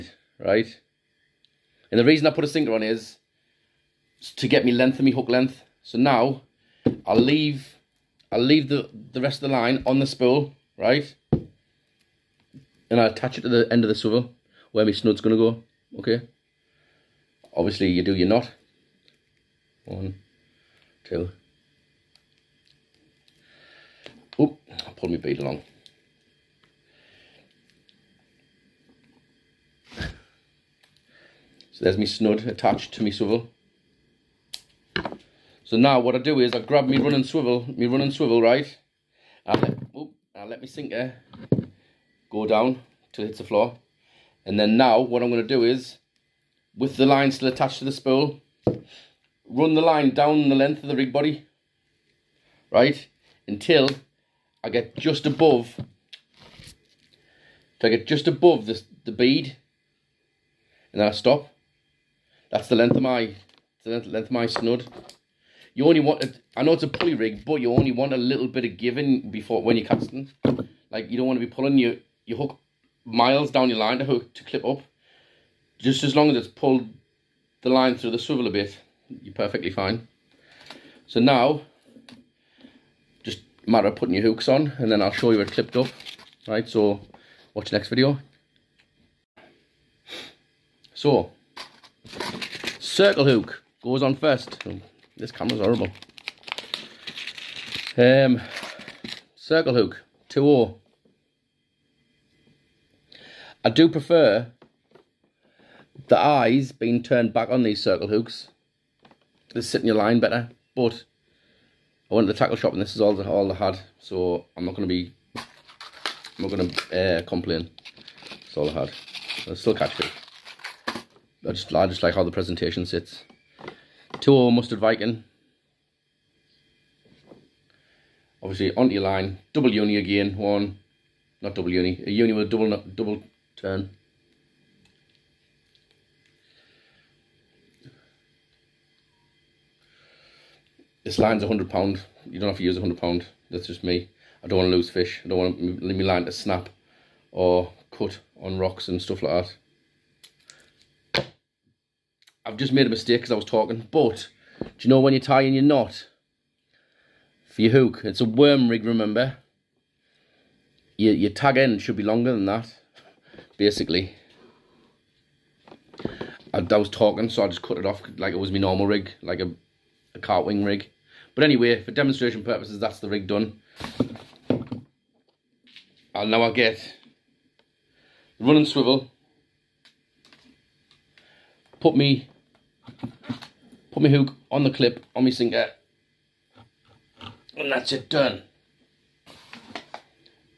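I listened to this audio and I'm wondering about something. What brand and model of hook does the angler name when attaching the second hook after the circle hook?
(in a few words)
Mustad Viking.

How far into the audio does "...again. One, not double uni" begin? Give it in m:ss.
2:09.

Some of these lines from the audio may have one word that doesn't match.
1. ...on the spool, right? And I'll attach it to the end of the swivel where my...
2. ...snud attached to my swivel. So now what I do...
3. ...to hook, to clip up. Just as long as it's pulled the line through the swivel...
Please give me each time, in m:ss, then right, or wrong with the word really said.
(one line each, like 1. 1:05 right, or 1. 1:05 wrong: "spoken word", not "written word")
1. 0:09 right
2. 0:32 right
3. 1:13 right.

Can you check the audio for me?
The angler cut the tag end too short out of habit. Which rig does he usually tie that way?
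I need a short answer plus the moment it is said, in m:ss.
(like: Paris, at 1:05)
wing rig, at 2:50.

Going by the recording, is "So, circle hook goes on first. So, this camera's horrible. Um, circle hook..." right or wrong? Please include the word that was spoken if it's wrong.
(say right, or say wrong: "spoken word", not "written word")
right.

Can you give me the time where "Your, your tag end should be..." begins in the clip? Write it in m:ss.
2:40.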